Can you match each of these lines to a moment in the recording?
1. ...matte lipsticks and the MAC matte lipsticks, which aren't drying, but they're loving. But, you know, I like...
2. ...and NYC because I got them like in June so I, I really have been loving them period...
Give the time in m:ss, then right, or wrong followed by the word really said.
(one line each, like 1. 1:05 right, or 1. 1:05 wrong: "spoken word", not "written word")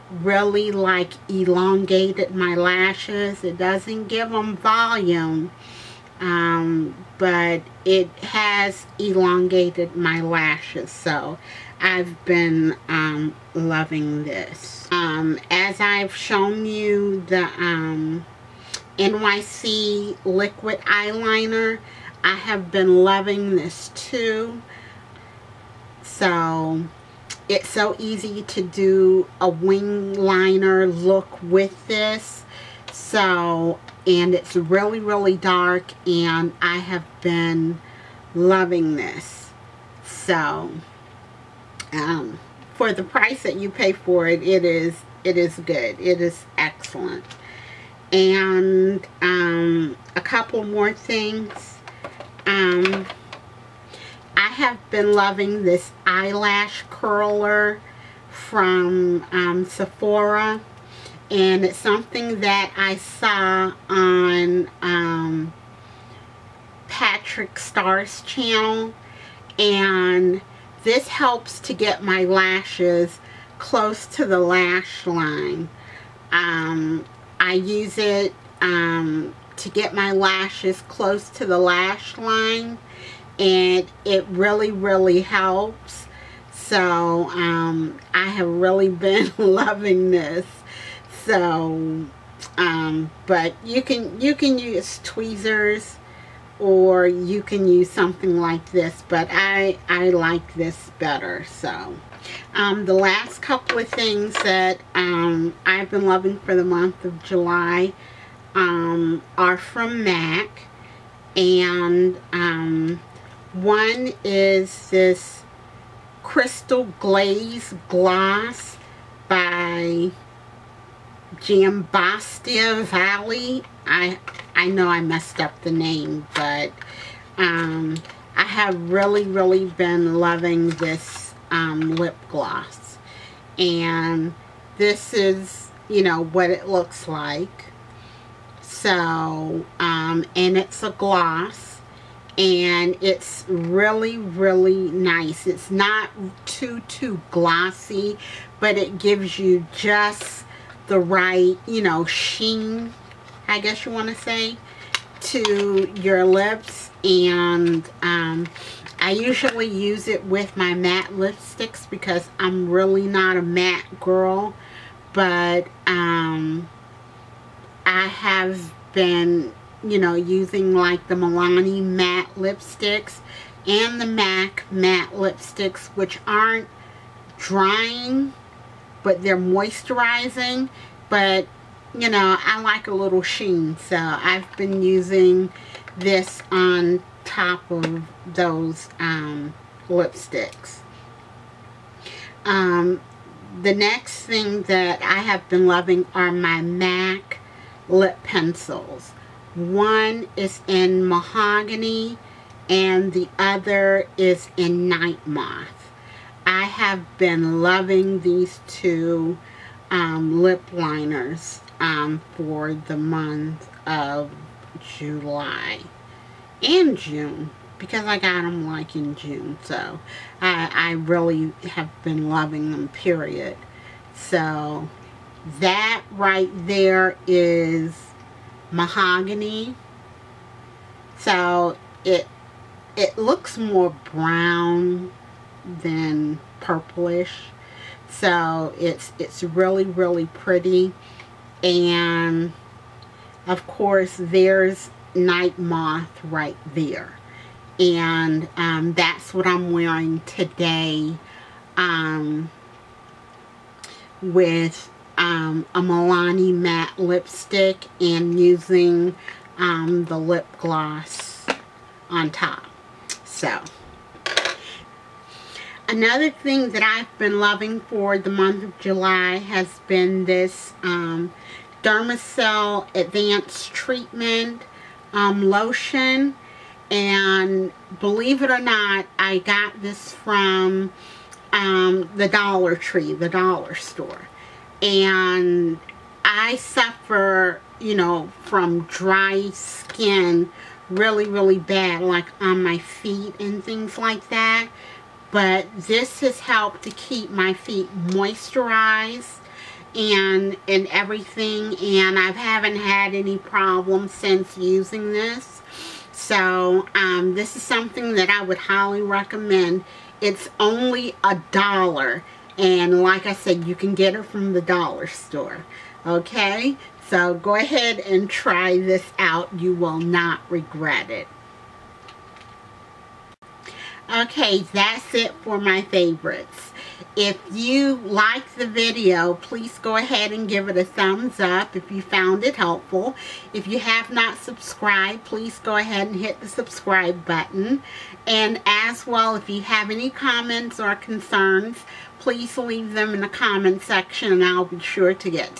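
1. 2:51 wrong: "moisturizing", not "loving"
2. 3:36 wrong: "June", not "NYC".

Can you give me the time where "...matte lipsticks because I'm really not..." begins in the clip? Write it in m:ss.
2:40.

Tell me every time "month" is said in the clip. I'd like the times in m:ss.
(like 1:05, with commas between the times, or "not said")
1:46, 3:32, 4:28.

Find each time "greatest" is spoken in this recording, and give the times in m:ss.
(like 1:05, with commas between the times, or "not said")
not said.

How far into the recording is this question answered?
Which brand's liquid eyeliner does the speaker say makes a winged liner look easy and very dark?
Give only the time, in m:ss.
0:18.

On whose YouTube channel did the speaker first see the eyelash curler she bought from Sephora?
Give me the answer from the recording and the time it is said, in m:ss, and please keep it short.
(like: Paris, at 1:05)
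Patrick Starr, at 1:06.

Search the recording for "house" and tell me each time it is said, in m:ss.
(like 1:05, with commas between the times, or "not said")
not said.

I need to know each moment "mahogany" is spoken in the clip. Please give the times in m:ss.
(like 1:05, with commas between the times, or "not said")
3:21, 3:48.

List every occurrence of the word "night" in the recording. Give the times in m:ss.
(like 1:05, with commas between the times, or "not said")
3:24, 4:05.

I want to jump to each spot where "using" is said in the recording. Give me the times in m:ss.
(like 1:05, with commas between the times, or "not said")
2:50, 3:04, 4:18, 5:04.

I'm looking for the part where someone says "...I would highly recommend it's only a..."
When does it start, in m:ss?
5:08.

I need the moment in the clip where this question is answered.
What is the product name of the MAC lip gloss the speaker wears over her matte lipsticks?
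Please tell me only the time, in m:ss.
1:56.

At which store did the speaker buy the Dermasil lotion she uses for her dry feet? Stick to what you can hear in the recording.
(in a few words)
Dollar Tree.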